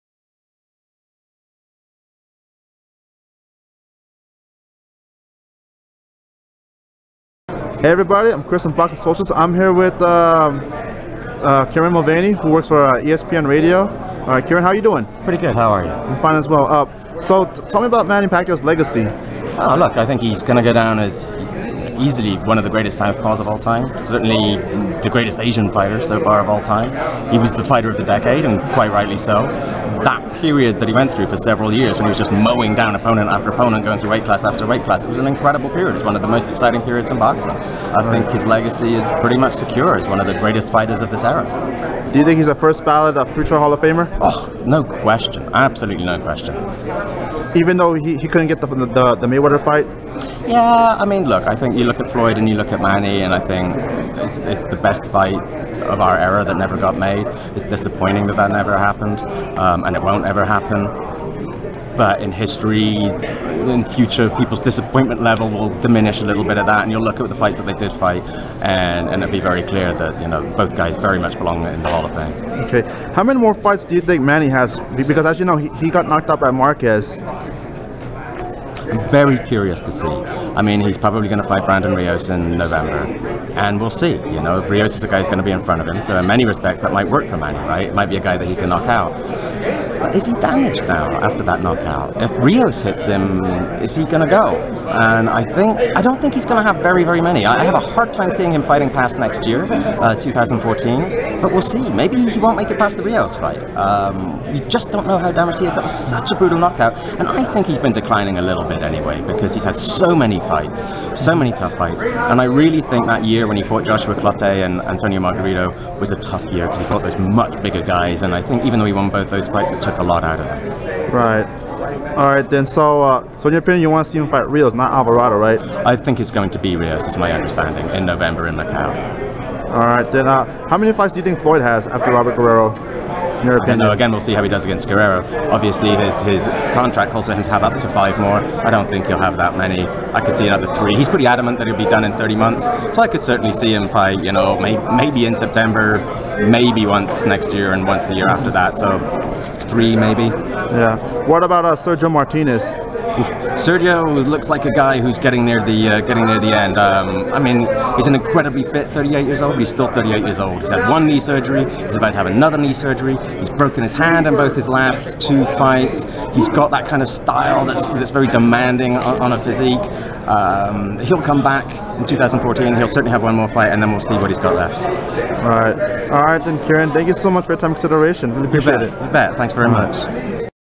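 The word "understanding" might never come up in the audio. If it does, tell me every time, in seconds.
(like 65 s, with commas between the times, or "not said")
127 s.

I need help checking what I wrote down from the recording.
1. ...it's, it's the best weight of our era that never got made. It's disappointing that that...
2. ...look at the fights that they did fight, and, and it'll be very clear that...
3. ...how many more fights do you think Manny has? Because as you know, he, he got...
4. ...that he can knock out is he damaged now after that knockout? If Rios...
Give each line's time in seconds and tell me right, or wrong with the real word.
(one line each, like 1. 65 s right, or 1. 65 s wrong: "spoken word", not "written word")
1. 54 s wrong: "fight", not "weight"
2. 67 s right
3. 73 s right
4. 88 s right.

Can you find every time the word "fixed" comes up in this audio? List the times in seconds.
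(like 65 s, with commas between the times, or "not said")
not said.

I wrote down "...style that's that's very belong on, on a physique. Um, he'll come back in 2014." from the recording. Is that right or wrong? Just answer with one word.
wrong.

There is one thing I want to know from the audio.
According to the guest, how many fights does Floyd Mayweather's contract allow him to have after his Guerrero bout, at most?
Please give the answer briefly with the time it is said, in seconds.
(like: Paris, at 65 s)
5, at 137 s.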